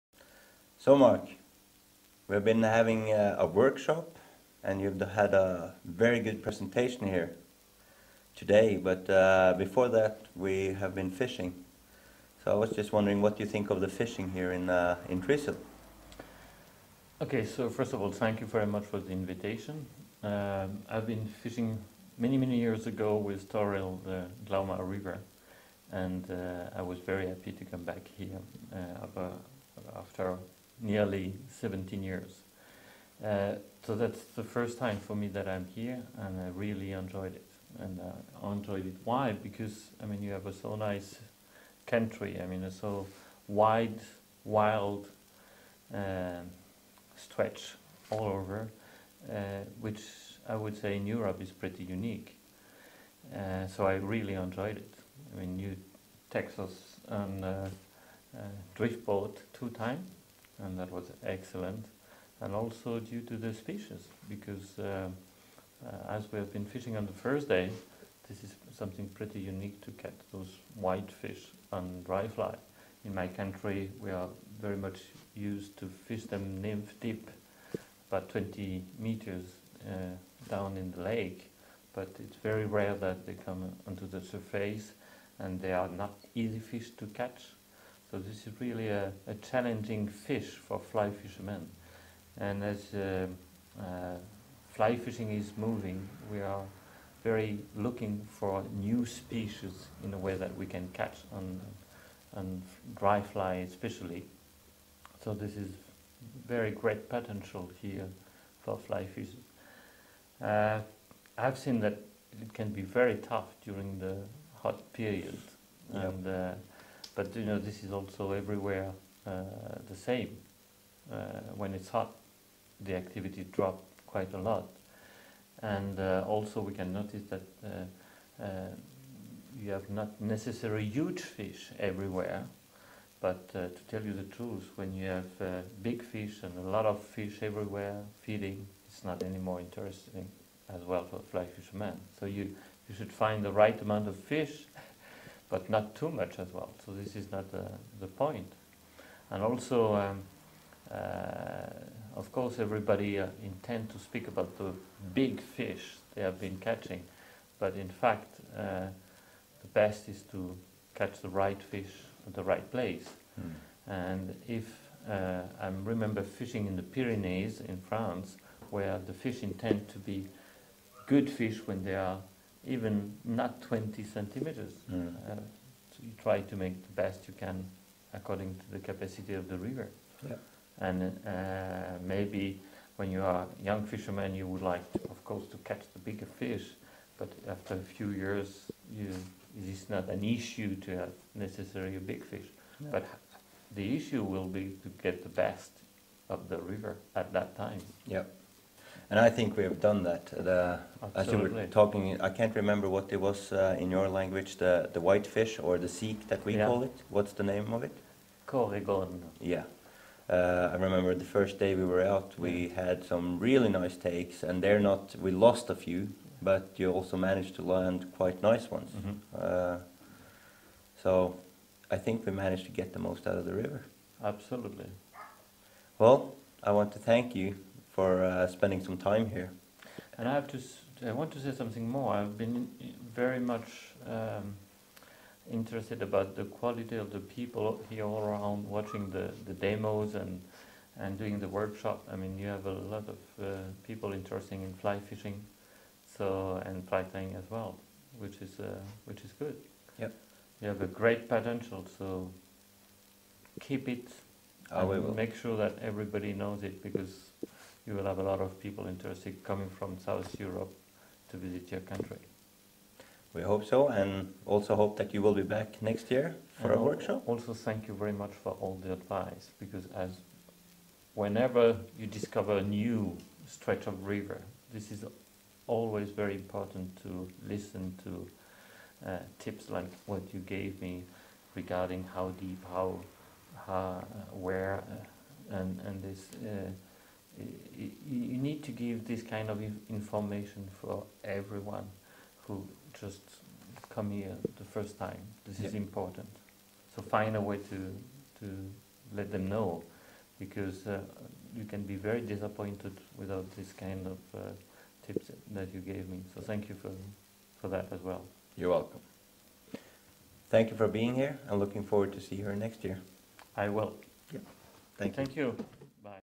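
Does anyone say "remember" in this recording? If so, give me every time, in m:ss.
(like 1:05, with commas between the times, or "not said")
2:45, 3:22, 3:30.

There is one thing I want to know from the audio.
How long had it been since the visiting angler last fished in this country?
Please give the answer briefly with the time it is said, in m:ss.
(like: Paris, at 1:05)
17 years, at 0:30.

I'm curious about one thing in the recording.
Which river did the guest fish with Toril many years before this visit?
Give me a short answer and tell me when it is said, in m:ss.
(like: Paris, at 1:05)
Glauma, at 0:24.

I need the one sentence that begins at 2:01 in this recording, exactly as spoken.
Uh, when it's hot, the activity drops quite a lot.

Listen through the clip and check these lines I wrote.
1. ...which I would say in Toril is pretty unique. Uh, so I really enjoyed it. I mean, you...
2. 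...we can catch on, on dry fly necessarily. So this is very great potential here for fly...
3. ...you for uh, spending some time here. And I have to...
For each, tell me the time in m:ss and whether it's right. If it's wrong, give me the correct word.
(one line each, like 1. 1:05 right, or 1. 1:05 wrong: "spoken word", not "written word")
1. 0:49 wrong: "Europe", not "Toril"
2. 1:40 wrong: "especially", not "necessarily"
3. 3:47 right.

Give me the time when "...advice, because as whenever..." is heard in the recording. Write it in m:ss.
4:28.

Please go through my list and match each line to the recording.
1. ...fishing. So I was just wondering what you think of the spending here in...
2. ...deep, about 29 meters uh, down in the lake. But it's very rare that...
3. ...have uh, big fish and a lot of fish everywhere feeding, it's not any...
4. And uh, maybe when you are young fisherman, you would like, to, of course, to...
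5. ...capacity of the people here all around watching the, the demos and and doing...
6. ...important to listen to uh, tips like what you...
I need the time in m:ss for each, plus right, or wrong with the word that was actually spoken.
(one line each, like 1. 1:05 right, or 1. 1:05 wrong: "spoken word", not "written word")
1. 0:11 wrong: "fishing", not "spending"
2. 1:16 wrong: "20", not "29"
3. 2:15 right
4. 3:00 right
5. 3:56 wrong: "quality", not "capacity"
6. 4:36 right.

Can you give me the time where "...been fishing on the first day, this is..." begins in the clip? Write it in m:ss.
1:06.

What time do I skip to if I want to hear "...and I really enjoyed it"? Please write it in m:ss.
0:36.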